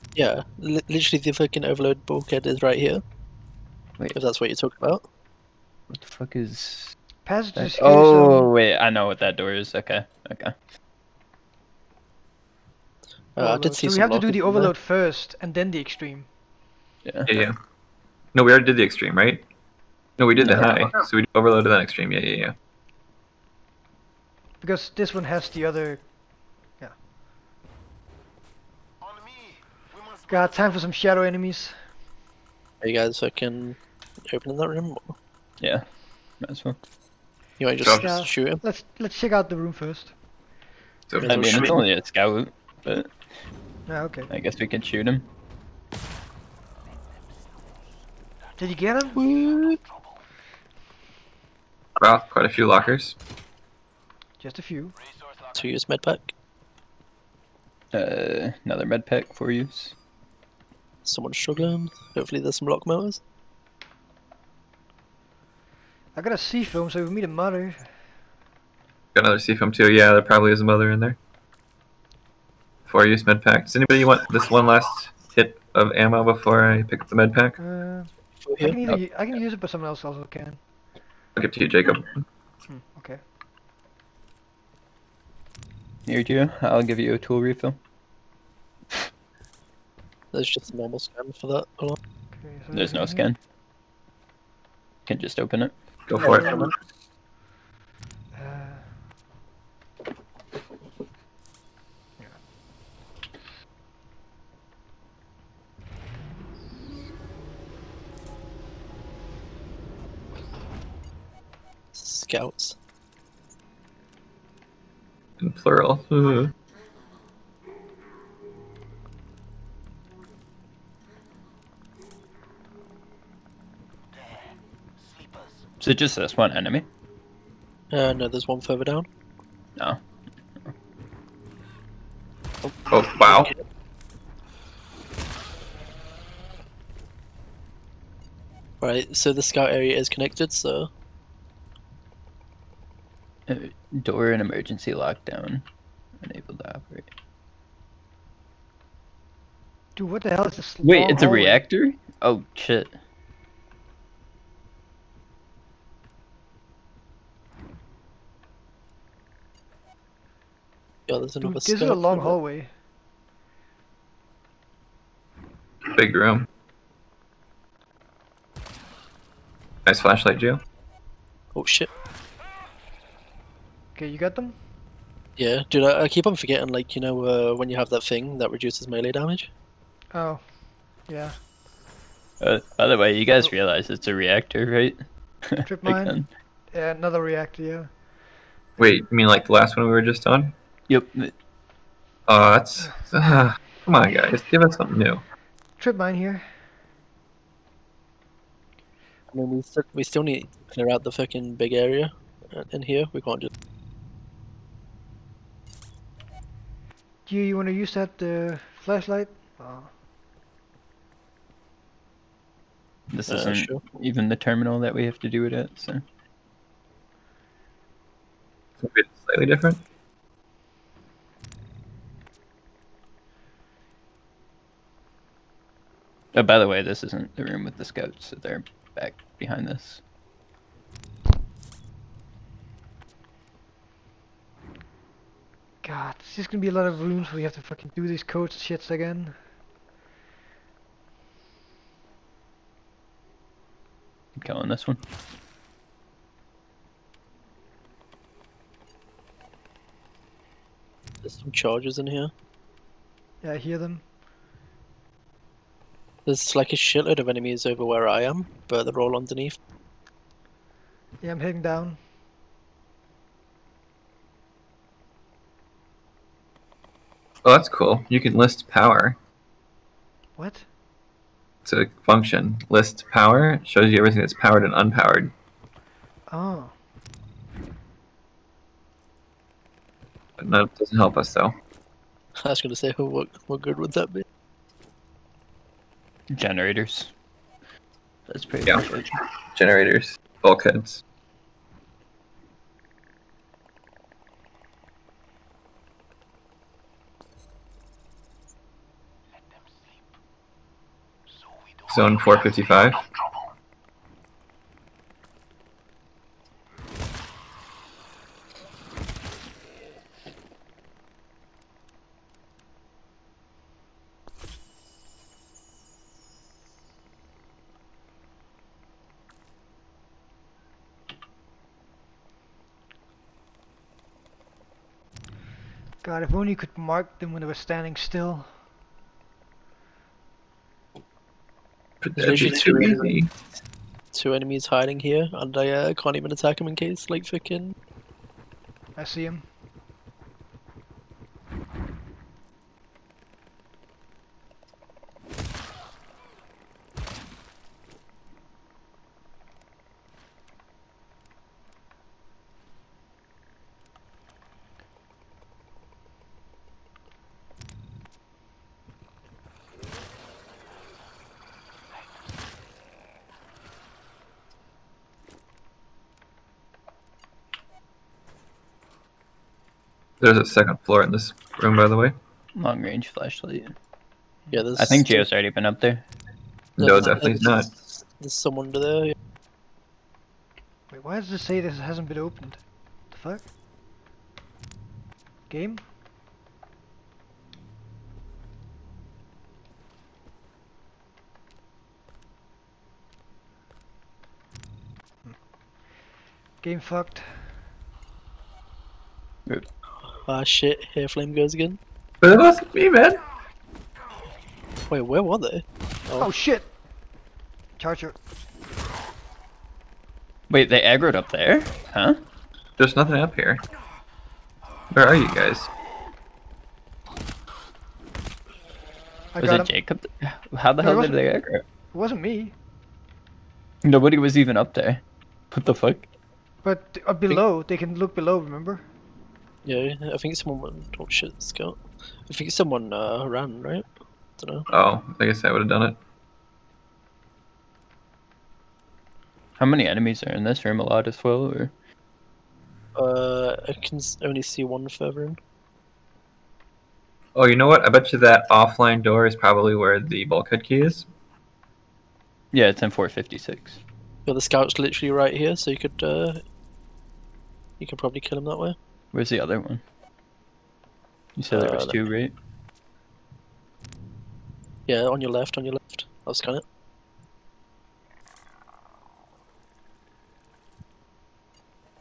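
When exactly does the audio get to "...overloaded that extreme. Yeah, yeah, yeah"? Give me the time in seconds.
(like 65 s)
21 s.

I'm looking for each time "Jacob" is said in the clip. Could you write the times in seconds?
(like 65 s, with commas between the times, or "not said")
81 s, 419 s.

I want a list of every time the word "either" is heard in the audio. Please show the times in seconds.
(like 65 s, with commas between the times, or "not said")
78 s.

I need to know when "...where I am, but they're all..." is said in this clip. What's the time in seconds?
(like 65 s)
257 s.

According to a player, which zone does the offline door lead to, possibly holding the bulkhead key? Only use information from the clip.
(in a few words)
456.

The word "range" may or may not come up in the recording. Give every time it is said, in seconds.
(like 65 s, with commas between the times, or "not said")
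372 s.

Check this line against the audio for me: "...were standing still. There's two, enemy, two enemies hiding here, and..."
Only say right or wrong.
right.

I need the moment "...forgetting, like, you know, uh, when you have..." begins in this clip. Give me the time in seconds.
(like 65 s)
176 s.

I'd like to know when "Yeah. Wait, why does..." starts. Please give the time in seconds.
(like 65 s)
379 s.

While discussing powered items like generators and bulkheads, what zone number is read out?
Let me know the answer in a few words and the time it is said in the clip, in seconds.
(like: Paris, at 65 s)
455, at 301 s.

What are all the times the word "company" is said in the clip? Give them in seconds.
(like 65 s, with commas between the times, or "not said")
not said.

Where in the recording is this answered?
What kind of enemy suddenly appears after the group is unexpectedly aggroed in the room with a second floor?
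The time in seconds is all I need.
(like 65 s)
407 s.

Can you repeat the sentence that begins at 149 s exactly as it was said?
Dude, what the hell is this?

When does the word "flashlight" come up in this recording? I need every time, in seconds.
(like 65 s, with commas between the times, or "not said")
169 s, 208 s, 373 s.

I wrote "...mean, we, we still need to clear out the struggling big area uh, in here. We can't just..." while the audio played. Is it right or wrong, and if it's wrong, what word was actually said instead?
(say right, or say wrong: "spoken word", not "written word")
wrong: "fucking", not "struggling".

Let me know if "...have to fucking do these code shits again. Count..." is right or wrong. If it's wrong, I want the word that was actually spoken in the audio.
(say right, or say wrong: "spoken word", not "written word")
right.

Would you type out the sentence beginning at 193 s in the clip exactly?
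Uh, come on, guys, give us something new.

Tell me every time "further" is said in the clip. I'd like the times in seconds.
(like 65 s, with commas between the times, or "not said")
128 s, 444 s.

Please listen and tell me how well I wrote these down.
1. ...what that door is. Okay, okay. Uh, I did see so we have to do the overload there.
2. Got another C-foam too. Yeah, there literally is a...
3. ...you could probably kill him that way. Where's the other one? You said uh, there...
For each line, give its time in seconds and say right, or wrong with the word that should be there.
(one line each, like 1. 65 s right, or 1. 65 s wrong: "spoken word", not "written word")
1. 9 s right
2. 69 s wrong: "probably", not "literally"
3. 457 s right.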